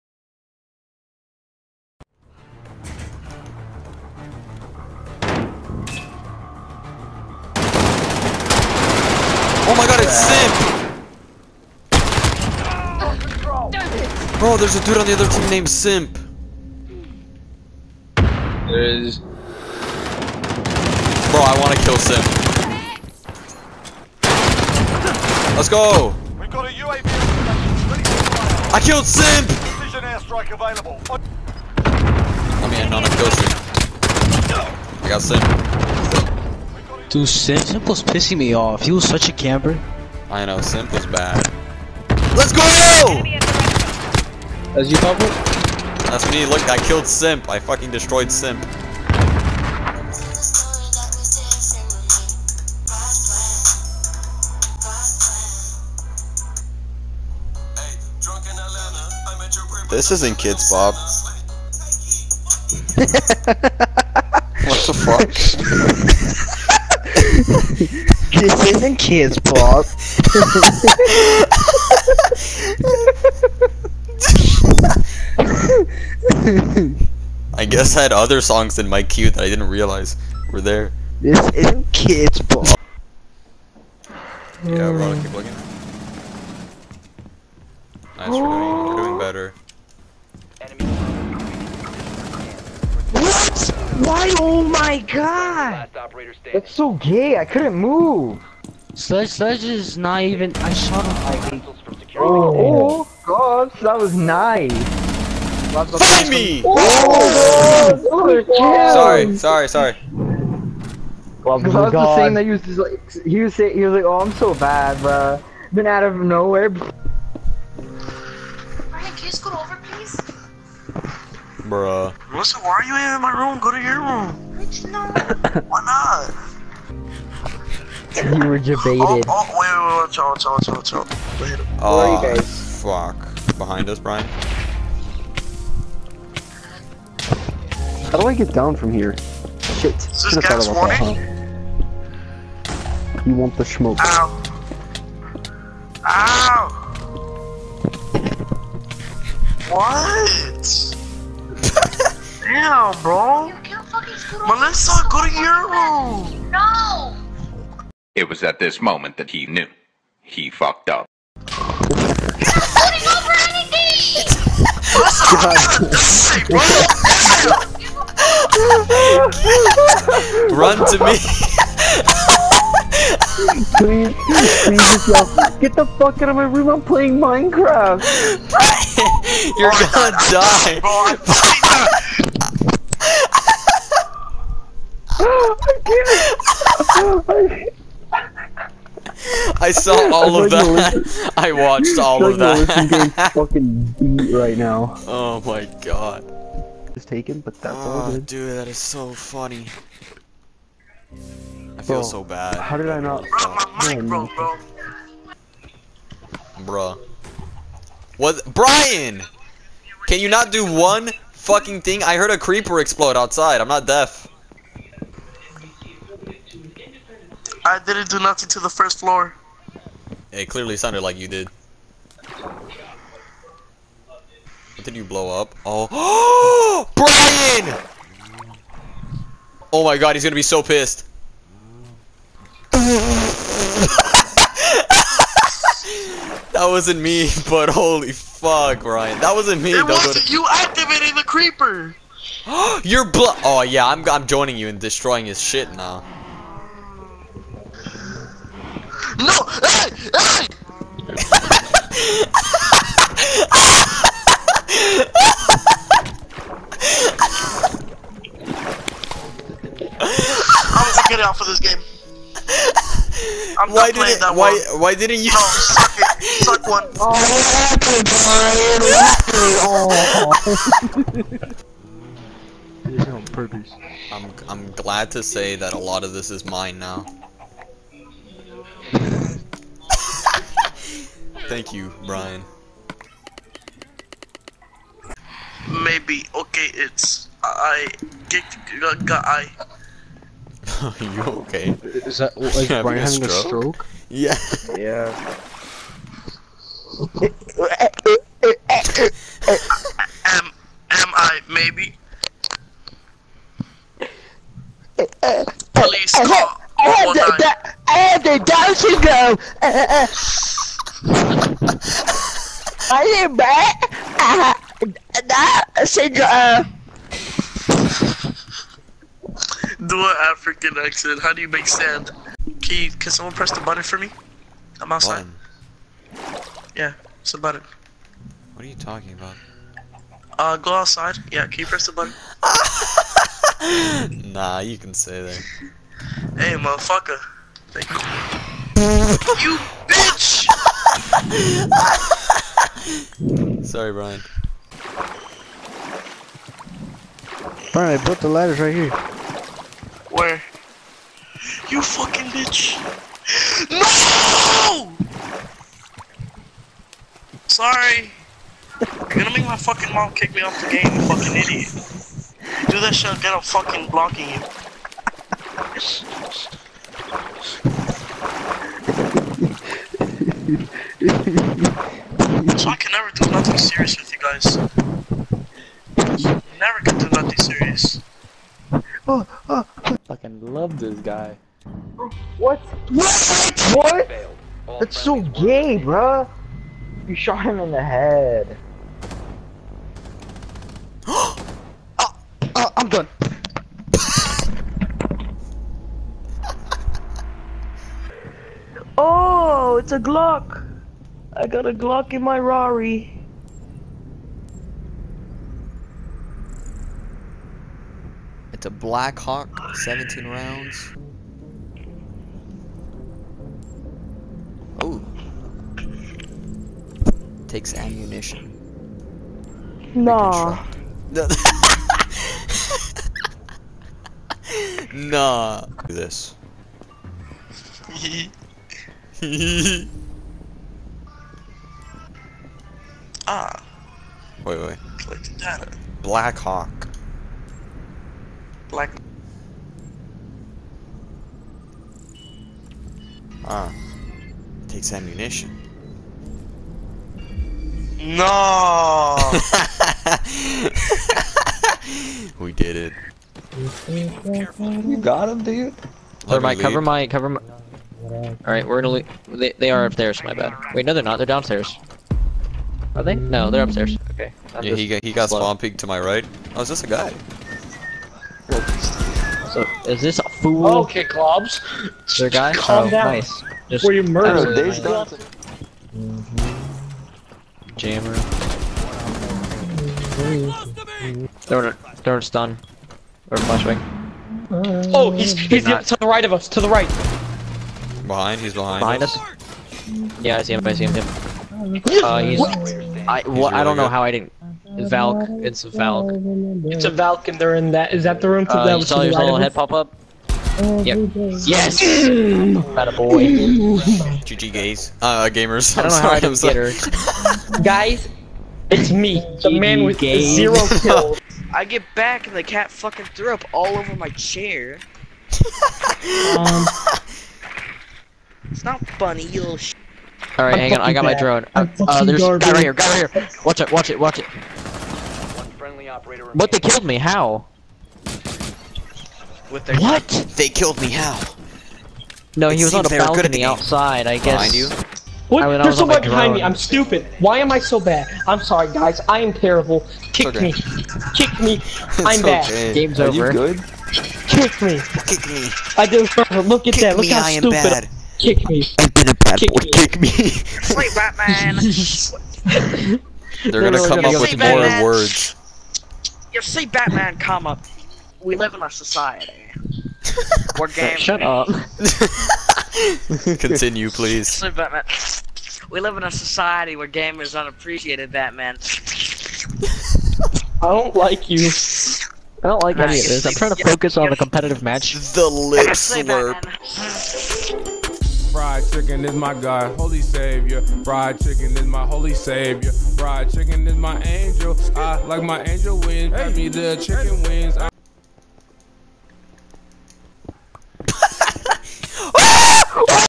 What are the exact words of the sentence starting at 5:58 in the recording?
You're gonna make my fucking mom kick me off the game, you fucking idiot.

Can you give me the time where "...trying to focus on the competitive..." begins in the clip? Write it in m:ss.
9:33.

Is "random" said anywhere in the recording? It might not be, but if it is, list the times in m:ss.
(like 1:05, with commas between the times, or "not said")
not said.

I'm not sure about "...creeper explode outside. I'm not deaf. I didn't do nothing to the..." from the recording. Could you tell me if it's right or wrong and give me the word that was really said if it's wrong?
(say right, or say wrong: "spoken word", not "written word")
right.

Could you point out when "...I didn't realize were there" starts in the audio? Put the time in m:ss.
1:19.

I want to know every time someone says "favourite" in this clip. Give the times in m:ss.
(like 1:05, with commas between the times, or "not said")
not said.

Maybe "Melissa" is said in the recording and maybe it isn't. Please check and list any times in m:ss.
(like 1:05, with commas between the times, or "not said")
2:02, 2:34.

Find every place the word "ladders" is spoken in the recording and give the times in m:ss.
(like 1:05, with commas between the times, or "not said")
5:48.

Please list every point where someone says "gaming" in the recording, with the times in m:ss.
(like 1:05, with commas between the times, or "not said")
9:20.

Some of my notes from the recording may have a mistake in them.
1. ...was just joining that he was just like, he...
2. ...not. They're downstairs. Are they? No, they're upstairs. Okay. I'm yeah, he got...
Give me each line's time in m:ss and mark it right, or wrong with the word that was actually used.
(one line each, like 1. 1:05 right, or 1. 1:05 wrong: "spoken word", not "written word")
1. 1:51 wrong: "saying", not "joining"
2. 7:41 right.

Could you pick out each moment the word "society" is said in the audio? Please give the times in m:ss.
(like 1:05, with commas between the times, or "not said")
9:18, 9:26.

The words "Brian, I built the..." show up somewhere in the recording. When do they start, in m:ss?
5:47.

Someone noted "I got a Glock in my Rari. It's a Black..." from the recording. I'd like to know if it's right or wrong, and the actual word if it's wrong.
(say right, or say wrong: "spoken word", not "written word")
right.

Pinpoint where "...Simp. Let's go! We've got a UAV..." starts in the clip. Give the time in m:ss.
0:21.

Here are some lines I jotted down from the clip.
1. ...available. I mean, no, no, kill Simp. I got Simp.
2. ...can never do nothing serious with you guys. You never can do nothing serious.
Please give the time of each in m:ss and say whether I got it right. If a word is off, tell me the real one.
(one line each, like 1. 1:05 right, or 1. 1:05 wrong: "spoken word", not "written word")
1. 0:30 right
2. 6:12 right.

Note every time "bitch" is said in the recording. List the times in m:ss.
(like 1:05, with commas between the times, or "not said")
5:39, 5:52.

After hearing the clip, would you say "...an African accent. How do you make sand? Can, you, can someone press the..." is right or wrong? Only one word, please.
right.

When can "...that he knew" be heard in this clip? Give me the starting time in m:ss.
2:39.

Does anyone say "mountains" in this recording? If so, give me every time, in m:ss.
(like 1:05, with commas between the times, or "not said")
not said.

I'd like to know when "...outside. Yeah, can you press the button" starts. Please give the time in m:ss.
5:30.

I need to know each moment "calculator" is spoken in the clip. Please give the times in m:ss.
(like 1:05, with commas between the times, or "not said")
not said.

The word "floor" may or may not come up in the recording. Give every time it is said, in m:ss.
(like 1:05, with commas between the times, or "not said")
3:38.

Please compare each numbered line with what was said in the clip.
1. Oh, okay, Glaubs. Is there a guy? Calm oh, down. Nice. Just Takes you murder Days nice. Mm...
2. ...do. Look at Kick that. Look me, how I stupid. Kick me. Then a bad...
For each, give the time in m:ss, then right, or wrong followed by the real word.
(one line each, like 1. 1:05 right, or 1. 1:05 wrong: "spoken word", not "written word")
1. 7:50 wrong: "Were", not "Takes"
2. 9:05 right.